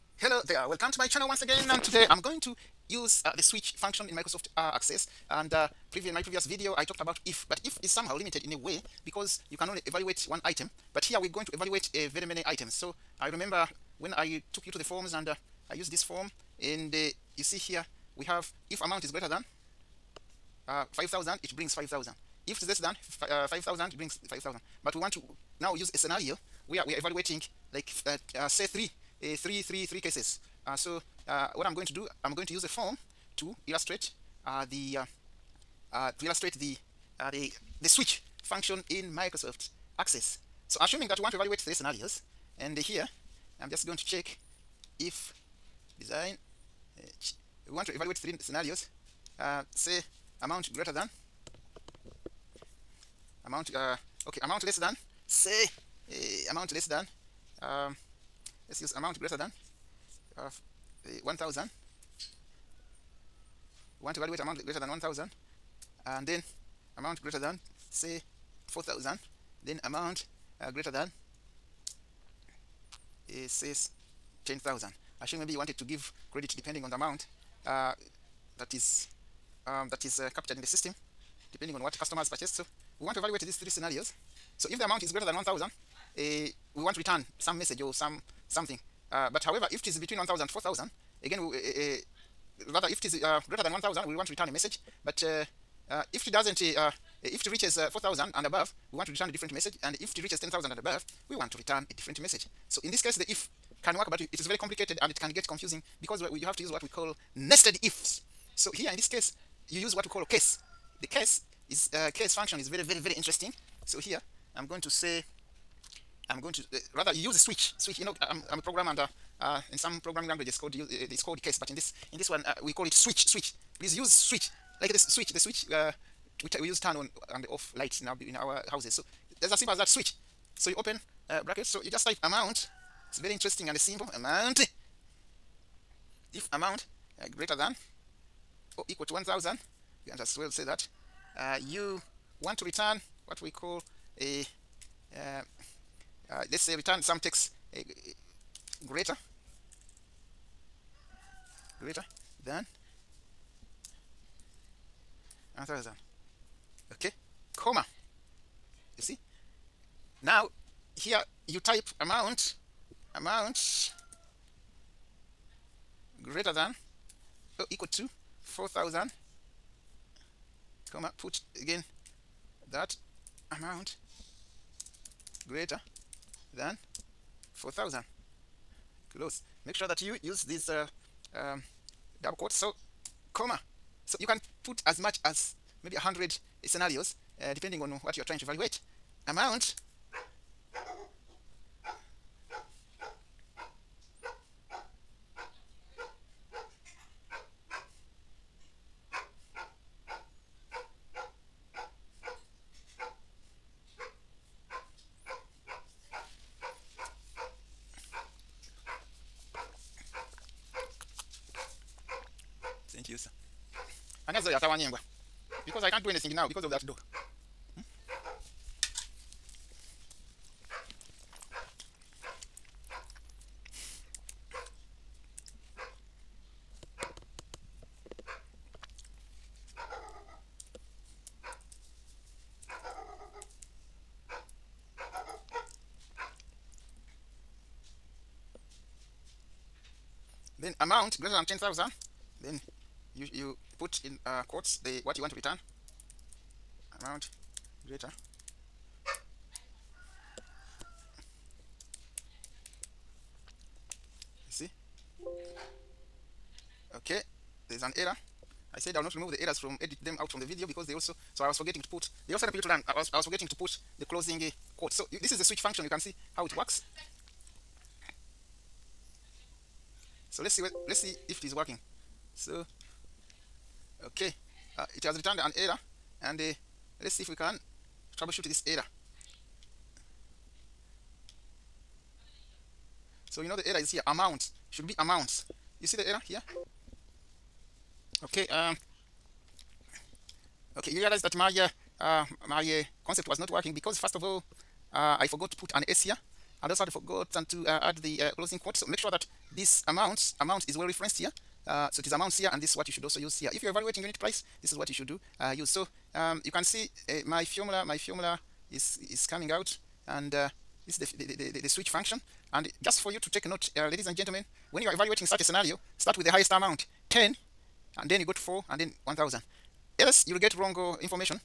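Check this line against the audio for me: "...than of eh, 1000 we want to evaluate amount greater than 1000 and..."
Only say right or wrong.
right.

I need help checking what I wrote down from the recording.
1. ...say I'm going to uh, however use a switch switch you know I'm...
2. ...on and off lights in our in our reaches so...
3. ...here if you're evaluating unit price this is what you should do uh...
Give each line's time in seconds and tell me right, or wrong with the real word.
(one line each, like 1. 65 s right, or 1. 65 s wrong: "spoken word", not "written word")
1. 114 s wrong: "rather", not "however"
2. 126 s wrong: "houses", not "reaches"
3. 303 s right.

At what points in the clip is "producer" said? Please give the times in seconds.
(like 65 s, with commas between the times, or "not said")
213 s.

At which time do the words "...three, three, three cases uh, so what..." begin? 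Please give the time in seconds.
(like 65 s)
29 s.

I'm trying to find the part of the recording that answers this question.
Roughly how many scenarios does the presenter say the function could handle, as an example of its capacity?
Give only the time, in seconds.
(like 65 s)
185 s.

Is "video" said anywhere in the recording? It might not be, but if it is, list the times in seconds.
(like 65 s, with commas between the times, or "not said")
6 s, 260 s.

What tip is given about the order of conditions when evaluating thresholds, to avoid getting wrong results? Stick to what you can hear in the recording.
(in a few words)
Start with the highest amount.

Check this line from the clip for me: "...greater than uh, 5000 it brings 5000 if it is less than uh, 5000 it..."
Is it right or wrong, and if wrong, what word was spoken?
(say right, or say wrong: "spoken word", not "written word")
right.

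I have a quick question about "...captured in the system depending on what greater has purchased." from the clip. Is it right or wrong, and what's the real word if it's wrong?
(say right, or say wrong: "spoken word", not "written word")
wrong: "customer", not "greater".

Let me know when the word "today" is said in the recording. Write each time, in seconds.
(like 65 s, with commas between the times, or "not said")
1 s.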